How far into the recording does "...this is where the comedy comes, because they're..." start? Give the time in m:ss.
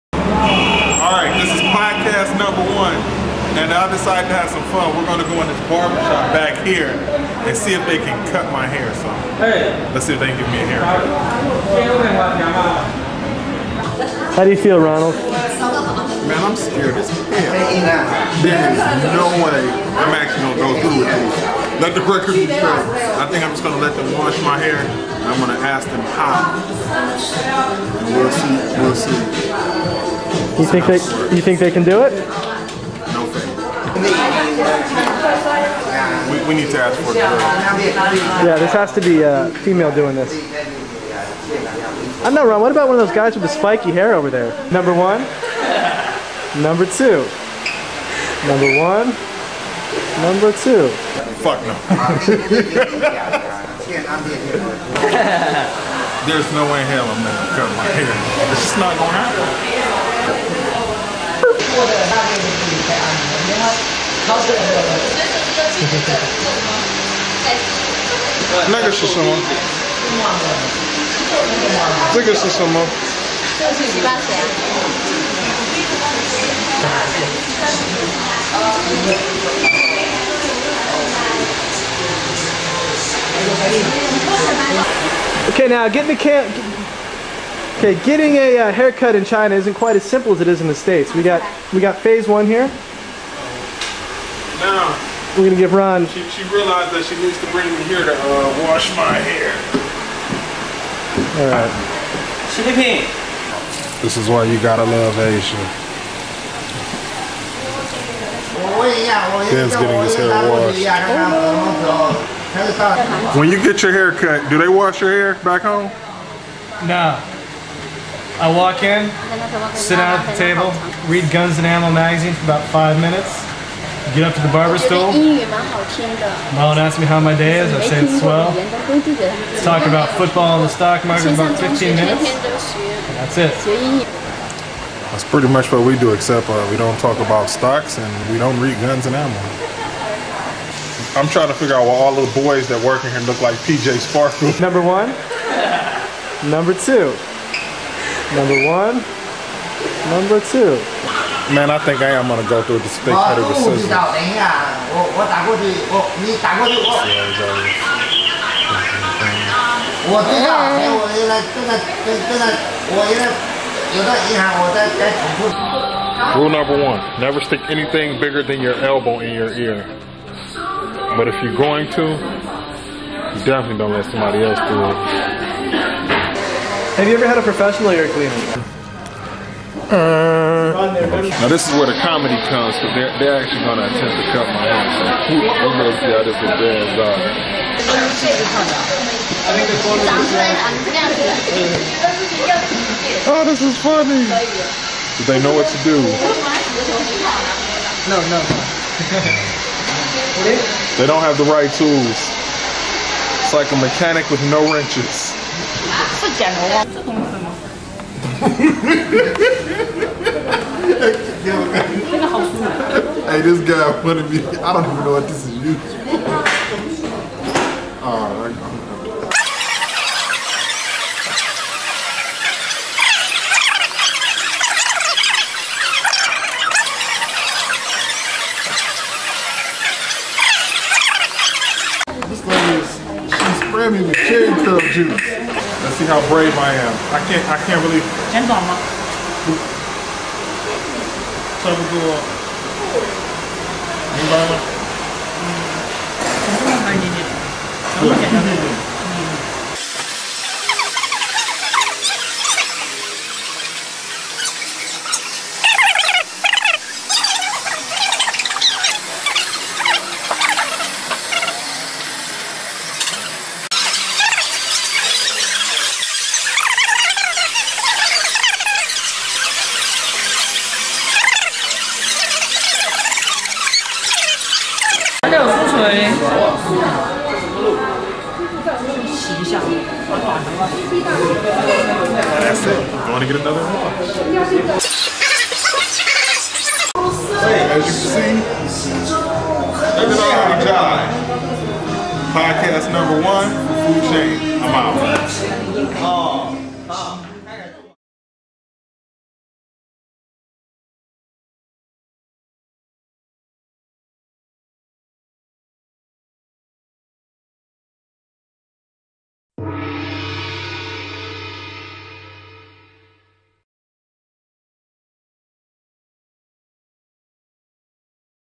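3:01.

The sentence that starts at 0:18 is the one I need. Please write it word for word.
There is no way I'm actually going to go through with this.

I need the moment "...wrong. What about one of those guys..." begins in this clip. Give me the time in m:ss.
0:42.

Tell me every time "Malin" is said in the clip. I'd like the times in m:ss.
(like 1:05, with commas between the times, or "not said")
2:06.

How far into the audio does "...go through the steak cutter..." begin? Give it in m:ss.
2:32.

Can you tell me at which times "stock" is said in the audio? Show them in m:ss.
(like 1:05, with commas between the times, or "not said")
2:10, 2:17.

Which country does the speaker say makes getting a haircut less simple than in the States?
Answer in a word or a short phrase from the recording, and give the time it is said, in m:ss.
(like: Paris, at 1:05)
China, at 1:29.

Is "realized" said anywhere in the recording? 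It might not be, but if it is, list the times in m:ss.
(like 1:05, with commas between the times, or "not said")
1:36.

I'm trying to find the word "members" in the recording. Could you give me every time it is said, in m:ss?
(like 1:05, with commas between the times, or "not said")
not said.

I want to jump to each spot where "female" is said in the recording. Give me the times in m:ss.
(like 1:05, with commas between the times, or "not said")
0:39.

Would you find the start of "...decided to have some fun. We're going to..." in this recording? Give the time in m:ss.
0:03.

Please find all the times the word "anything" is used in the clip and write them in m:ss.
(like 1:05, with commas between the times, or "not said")
2:47.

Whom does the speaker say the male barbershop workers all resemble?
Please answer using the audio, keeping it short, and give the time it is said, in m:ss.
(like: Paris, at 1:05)
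PJ Sparkle, at 2:23.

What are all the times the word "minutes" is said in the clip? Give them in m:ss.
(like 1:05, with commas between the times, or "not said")
2:03, 2:11.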